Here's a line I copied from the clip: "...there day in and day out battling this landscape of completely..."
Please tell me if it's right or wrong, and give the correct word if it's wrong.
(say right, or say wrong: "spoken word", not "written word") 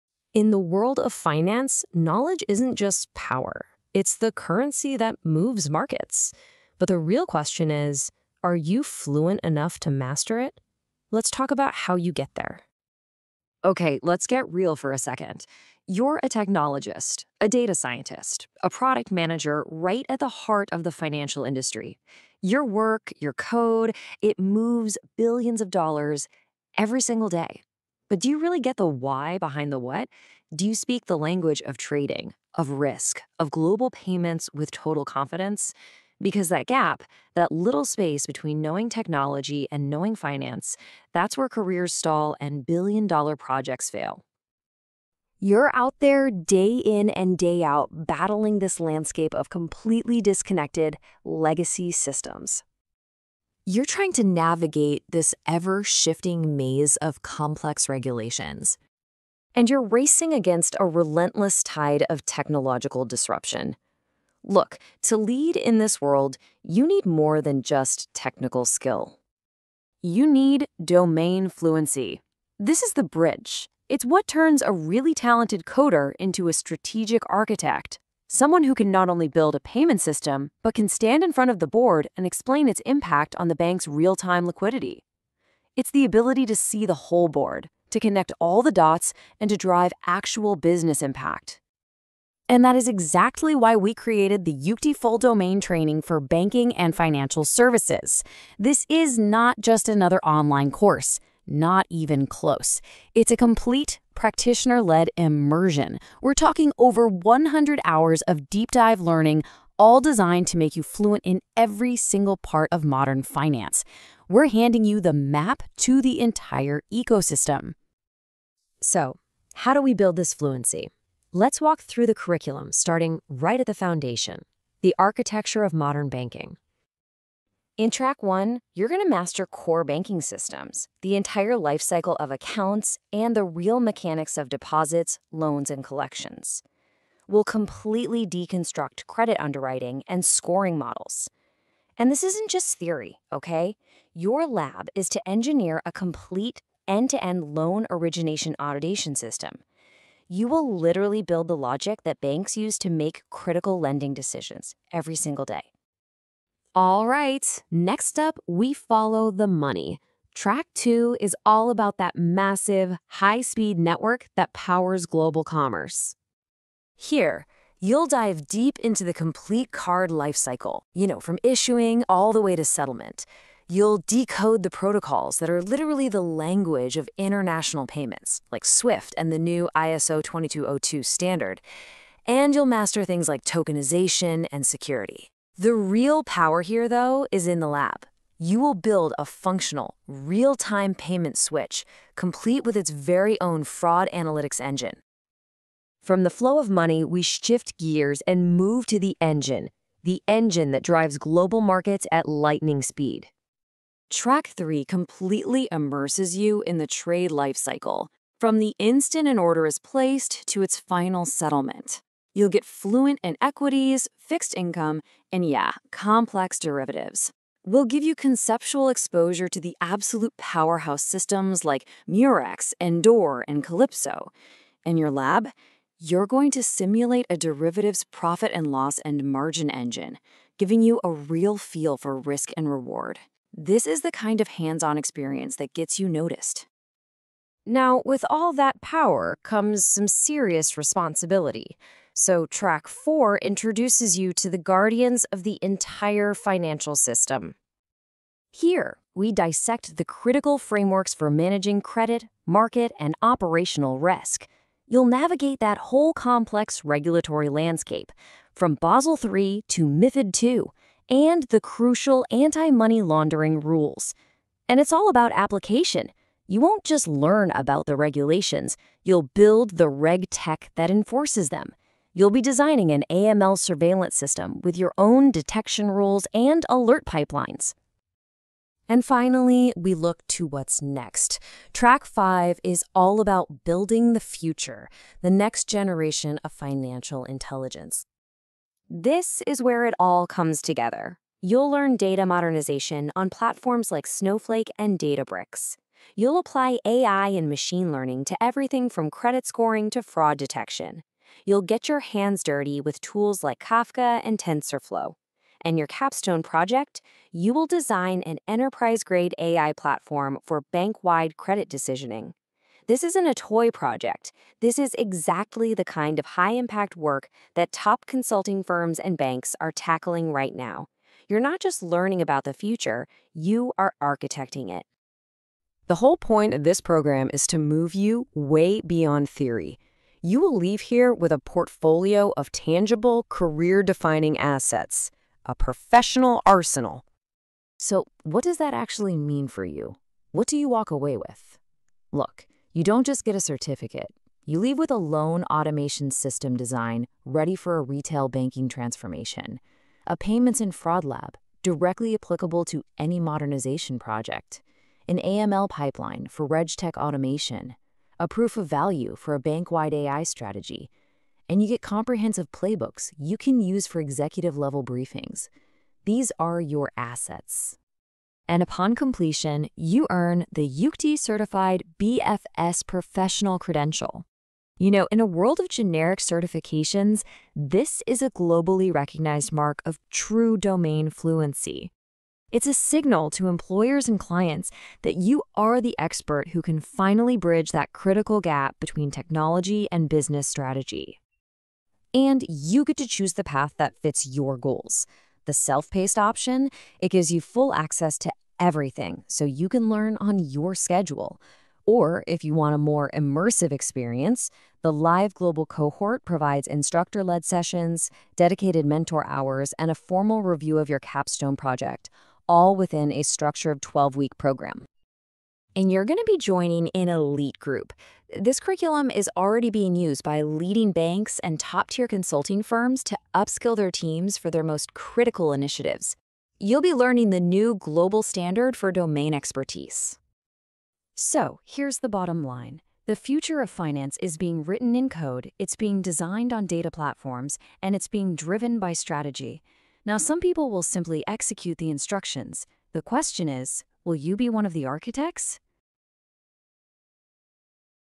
right.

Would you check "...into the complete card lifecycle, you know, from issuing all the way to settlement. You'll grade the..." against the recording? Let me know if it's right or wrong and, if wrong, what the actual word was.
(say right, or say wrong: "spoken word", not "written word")
wrong: "decode", not "grade".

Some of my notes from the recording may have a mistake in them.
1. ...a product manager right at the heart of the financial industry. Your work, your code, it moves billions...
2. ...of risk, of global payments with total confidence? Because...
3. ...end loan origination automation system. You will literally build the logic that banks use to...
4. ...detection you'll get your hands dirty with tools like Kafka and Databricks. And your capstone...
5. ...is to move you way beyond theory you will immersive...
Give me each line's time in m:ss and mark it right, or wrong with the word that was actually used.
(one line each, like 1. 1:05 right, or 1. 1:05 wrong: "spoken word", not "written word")
1. 0:18 right
2. 0:32 right
3. 2:27 right
4. 5:00 wrong: "TensorFlow", not "Databricks"
5. 5:27 wrong: "leave", not "immersive".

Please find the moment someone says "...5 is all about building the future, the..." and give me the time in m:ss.
4:42.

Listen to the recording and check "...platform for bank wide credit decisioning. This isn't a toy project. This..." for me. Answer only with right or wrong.
right.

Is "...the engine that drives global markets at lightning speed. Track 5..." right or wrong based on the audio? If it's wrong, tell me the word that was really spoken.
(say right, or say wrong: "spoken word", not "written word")
wrong: "3", not "5".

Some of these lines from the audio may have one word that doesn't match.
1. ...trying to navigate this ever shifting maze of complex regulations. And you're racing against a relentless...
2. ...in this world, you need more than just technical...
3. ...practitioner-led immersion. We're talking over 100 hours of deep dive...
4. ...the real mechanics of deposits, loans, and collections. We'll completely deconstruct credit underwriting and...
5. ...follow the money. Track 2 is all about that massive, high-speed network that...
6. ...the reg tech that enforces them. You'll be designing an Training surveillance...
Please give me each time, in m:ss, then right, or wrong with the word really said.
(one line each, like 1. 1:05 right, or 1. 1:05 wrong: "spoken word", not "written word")
1. 0:53 right
2. 1:05 right
3. 1:44 right
4. 2:13 right
5. 2:38 right
6. 4:29 wrong: "AML", not "Training".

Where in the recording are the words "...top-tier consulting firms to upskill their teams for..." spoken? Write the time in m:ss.
7:01.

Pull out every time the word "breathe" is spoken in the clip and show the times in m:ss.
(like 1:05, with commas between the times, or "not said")
not said.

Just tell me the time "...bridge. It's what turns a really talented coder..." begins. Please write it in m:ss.
1:13.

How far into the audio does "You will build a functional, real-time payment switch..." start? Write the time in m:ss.
3:08.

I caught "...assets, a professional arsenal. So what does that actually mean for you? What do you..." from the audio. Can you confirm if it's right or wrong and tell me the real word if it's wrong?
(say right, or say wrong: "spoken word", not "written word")
right.